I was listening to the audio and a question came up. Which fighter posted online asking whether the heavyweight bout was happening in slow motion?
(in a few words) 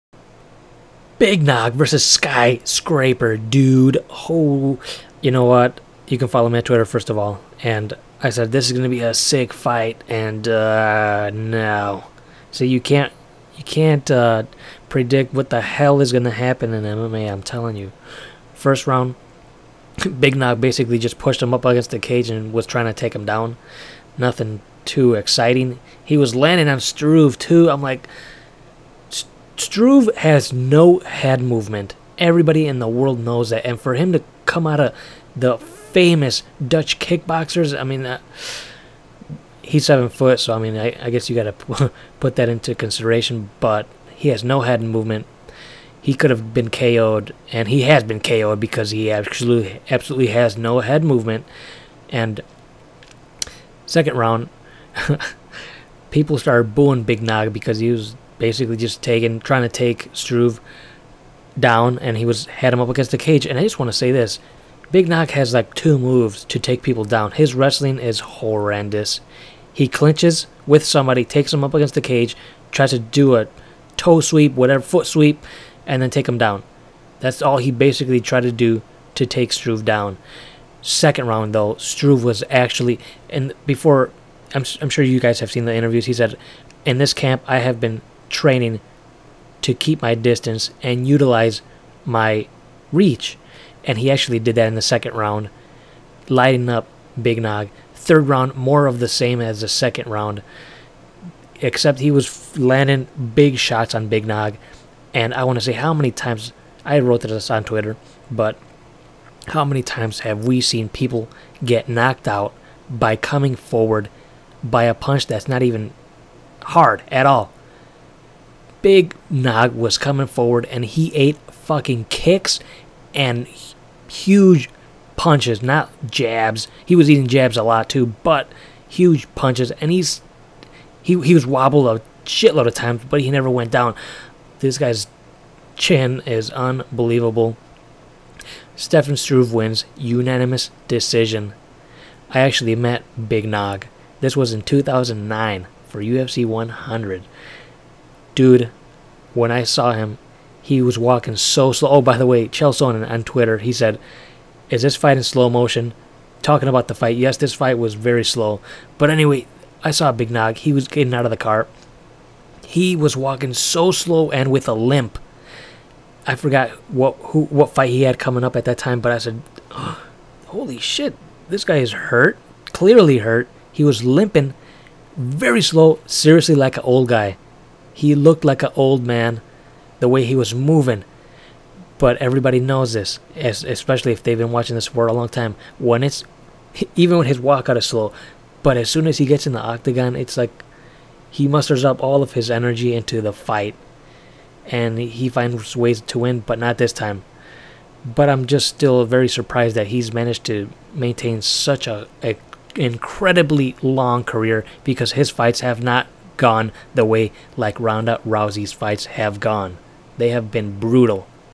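Chael Sonnen.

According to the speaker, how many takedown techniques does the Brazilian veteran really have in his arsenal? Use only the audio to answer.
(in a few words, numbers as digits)
2.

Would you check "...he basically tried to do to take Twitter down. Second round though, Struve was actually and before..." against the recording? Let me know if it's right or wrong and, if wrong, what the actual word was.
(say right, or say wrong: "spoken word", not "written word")
wrong: "Struve", not "Twitter".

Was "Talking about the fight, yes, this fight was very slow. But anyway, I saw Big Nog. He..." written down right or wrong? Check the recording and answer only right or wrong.
right.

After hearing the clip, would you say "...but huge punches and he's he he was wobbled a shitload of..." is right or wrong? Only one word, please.
right.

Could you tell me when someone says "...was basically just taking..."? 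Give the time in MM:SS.
00:57.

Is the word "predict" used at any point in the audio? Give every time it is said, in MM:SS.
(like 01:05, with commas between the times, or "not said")
00:14.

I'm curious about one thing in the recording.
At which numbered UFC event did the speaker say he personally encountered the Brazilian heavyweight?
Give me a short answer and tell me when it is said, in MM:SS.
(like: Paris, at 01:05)
UFC 100, at 02:26.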